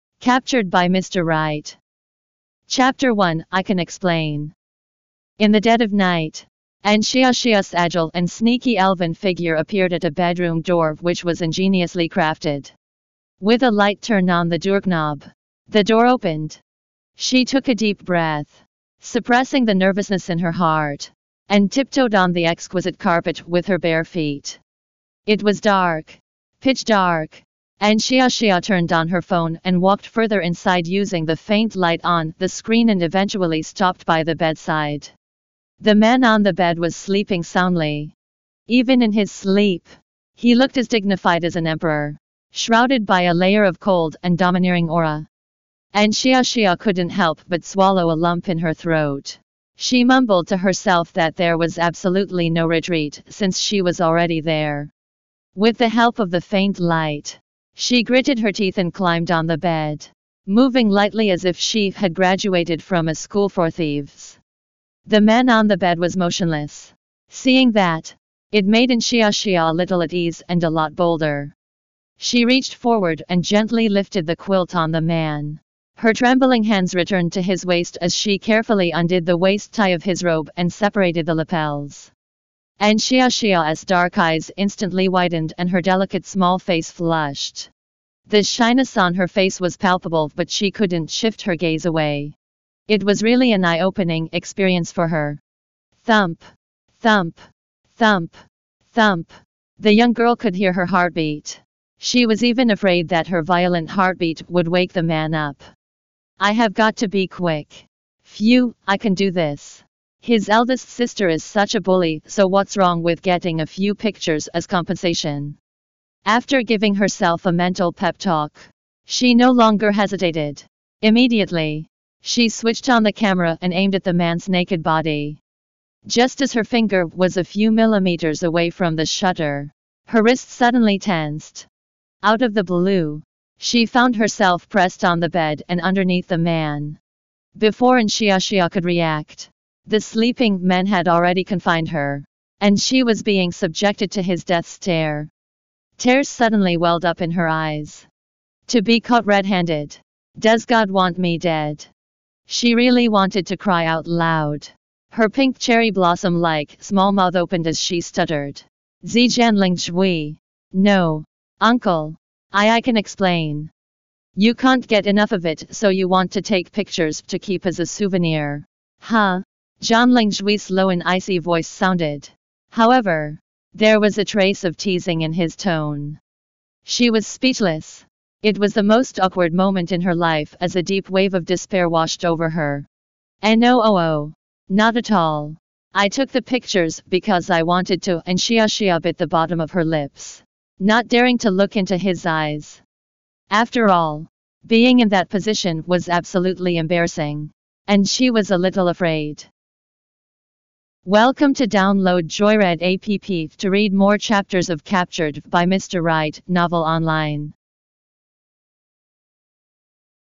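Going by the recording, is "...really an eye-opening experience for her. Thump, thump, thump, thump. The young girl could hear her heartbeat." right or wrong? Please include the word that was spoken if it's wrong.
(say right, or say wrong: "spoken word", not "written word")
right.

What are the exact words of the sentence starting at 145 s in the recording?
Tears suddenly welled up in her eyes.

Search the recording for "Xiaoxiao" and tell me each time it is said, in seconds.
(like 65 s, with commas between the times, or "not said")
7 s, 46 s, 138 s.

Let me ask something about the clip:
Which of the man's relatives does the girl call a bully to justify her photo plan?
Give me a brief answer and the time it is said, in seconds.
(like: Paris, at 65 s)
His eldest sister, at 110 s.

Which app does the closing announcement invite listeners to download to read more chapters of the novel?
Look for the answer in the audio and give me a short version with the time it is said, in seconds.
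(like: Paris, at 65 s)
Joyread, at 202 s.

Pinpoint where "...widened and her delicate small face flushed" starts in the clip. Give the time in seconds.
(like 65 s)
85 s.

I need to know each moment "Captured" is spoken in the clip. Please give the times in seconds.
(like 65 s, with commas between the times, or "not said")
0 s, 204 s.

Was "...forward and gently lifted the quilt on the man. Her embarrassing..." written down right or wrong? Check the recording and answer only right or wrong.
wrong.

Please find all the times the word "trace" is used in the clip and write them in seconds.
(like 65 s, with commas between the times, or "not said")
174 s.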